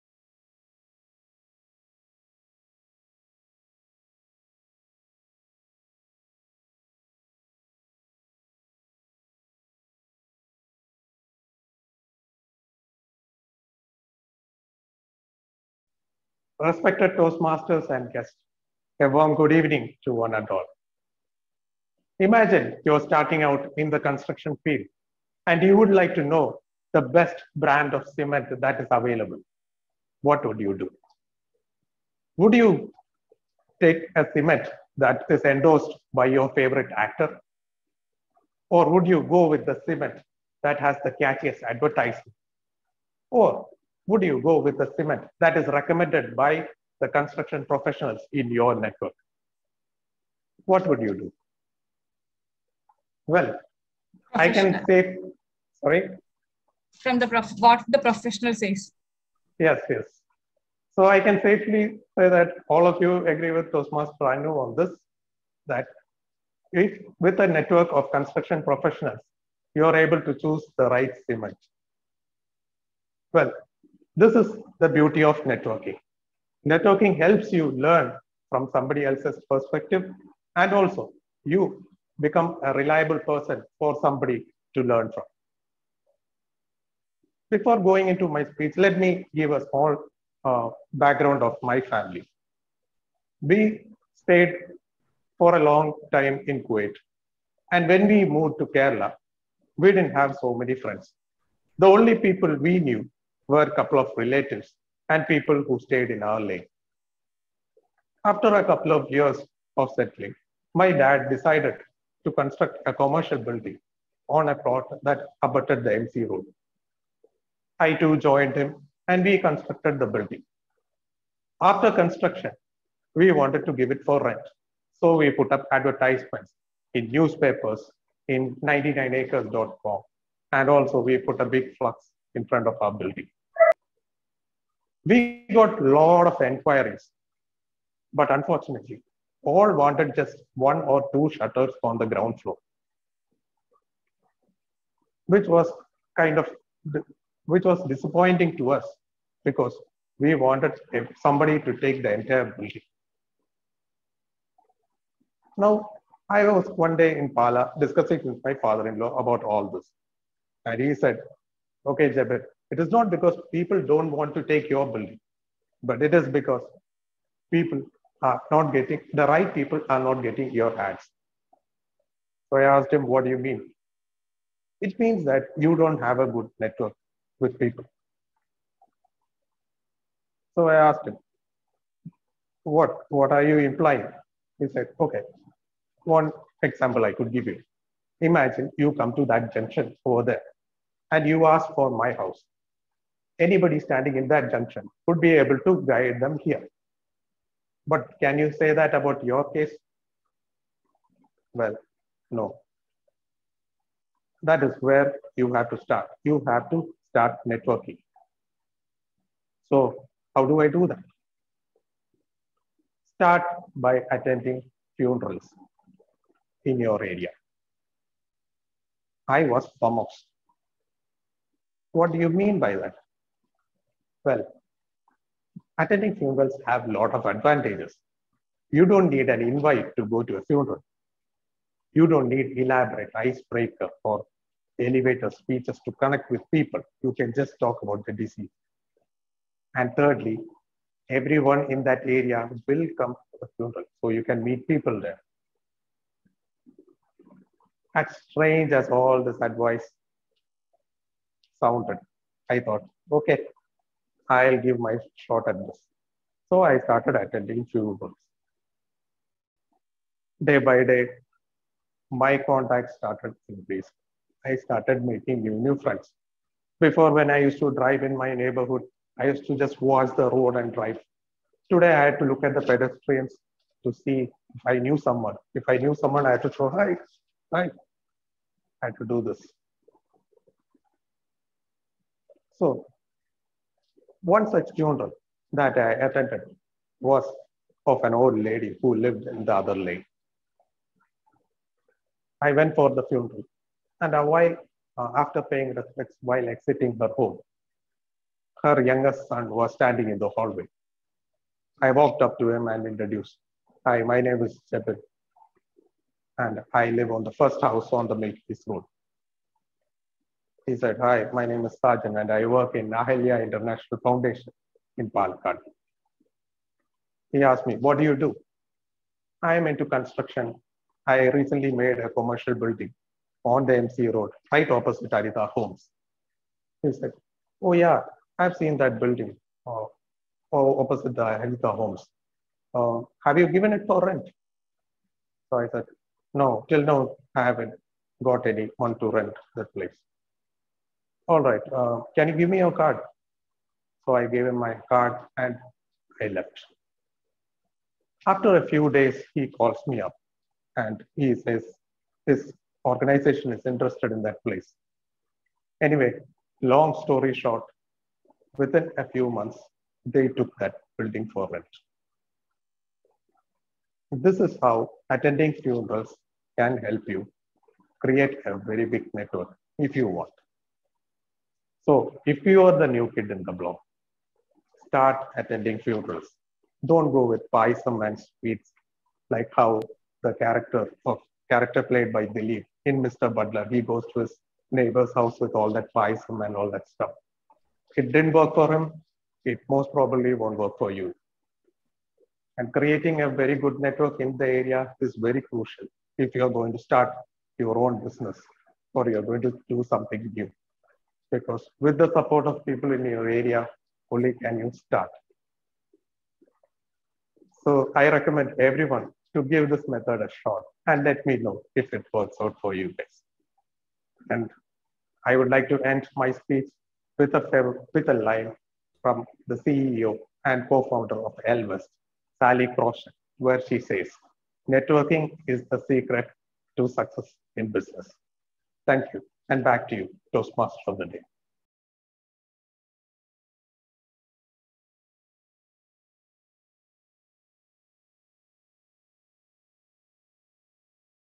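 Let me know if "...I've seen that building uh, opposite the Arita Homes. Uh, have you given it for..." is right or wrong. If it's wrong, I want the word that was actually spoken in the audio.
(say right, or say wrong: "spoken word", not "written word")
right.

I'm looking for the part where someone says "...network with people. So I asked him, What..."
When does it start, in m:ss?
2:56.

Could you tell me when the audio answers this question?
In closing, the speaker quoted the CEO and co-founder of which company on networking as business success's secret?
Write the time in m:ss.
7:01.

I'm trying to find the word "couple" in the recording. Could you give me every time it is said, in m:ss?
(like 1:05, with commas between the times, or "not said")
1:43, 1:48.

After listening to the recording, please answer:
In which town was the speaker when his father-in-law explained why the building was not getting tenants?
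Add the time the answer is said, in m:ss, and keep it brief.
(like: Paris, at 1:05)
Pala, at 2:37.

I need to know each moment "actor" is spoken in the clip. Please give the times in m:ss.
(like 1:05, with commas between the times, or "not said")
0:36.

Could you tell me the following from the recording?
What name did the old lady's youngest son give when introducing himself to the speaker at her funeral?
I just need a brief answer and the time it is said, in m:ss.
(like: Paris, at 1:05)
Sajan, at 5:11.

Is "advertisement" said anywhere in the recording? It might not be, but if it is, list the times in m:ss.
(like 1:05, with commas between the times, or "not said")
0:41, 2:05.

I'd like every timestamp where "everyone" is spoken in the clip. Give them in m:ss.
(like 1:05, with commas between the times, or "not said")
4:01, 6:48.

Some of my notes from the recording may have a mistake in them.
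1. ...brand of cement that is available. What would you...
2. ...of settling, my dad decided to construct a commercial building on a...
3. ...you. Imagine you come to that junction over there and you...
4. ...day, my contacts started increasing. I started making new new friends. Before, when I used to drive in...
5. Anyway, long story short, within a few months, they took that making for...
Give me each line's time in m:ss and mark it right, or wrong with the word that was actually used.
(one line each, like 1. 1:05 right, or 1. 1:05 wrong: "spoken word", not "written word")
1. 0:27 right
2. 1:49 right
3. 3:07 right
4. 4:20 right
5. 5:55 wrong: "building", not "making".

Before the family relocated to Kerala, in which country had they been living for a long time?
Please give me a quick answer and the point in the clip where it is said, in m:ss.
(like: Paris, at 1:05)
Kuwait, at 1:36.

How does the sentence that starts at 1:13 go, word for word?
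Well, this is the beauty of networking.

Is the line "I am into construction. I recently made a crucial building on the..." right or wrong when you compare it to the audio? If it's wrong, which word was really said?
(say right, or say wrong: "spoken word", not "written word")
wrong: "commercial", not "crucial".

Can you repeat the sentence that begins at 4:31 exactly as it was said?
Today, I had to look at the pedestrians to see if I knew someone.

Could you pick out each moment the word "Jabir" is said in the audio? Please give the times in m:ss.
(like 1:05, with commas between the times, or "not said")
2:42.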